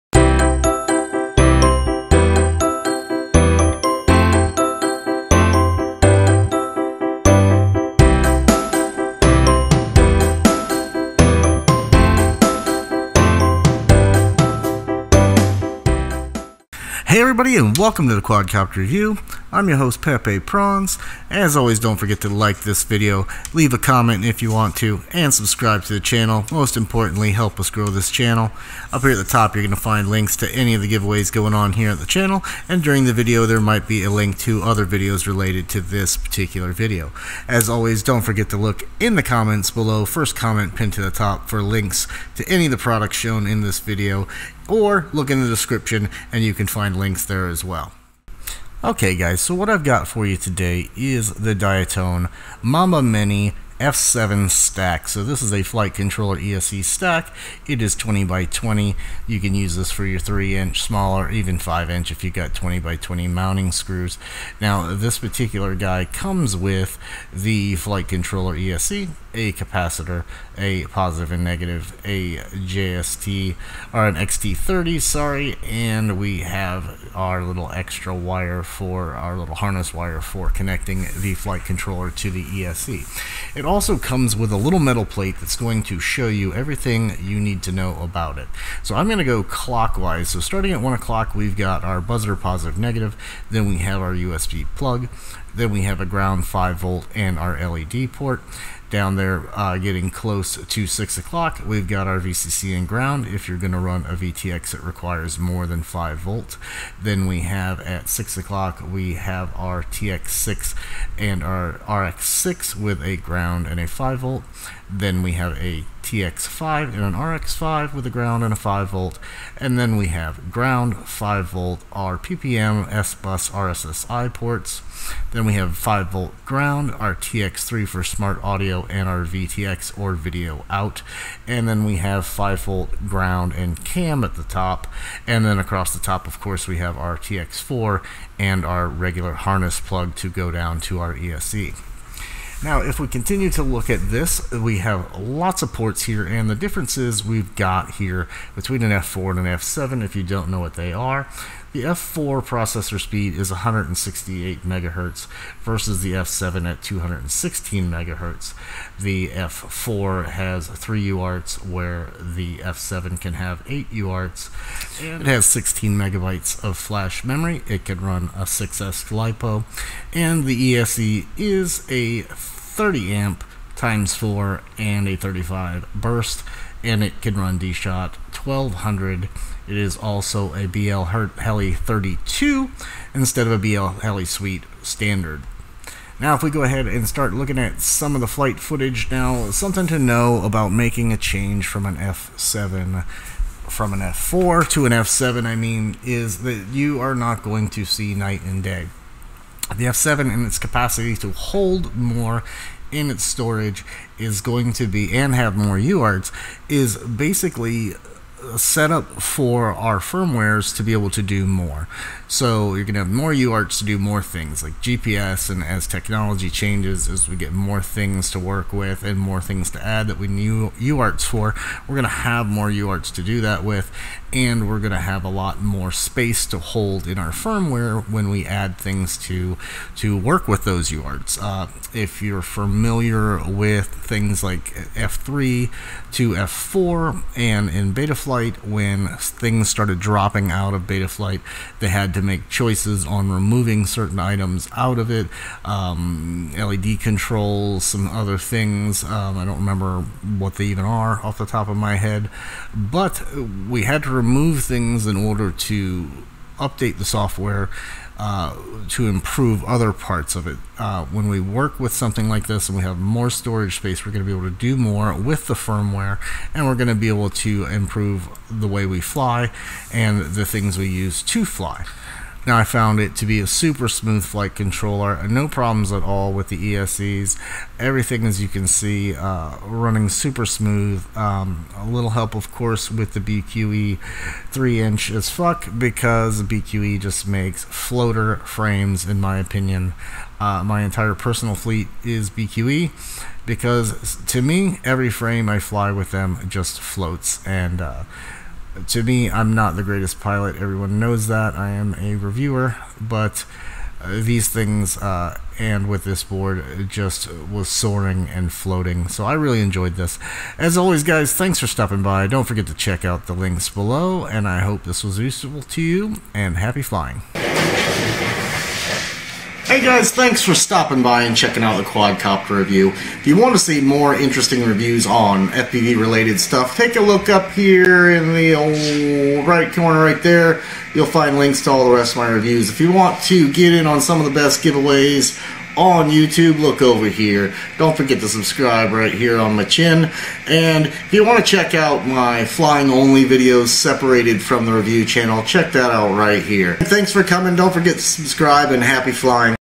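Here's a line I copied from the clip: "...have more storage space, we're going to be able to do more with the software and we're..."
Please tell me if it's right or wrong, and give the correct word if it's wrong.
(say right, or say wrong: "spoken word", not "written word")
wrong: "firmware", not "software".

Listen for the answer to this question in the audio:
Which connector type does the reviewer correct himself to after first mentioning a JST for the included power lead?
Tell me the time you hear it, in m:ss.
1:14.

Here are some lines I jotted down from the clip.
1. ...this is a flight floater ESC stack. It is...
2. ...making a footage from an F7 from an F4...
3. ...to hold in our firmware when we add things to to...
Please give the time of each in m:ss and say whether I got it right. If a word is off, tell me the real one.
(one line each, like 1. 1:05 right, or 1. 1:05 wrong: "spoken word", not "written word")
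1. 0:55 wrong: "controller", not "floater"
2. 3:10 wrong: "change", not "footage"
3. 3:46 right.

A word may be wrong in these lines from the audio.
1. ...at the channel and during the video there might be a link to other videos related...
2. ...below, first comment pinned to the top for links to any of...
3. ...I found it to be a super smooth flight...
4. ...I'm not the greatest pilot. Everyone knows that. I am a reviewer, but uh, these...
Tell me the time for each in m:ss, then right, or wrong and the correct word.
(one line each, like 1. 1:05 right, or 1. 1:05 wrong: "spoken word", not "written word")
1. 0:31 right
2. 0:39 right
3. 4:32 right
4. 4:59 right.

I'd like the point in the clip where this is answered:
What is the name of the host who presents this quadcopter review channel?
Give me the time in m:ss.
0:20.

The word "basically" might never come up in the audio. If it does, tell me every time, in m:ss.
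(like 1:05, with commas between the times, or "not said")
3:26.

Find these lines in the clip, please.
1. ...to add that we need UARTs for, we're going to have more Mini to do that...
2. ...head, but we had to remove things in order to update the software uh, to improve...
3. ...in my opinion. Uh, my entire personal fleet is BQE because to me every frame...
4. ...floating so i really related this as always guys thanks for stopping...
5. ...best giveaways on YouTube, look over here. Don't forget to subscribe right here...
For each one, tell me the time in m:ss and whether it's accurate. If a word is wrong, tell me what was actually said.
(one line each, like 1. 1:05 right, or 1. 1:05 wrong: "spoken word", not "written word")
1. 3:39 wrong: "UARTs", not "Mini"
2. 4:11 right
3. 4:49 right
4. 5:08 wrong: "enjoyed", not "related"
5. 5:34 right.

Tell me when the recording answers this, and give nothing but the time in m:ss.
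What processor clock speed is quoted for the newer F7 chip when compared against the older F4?
2:36.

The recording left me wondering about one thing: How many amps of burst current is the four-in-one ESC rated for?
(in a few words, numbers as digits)
35.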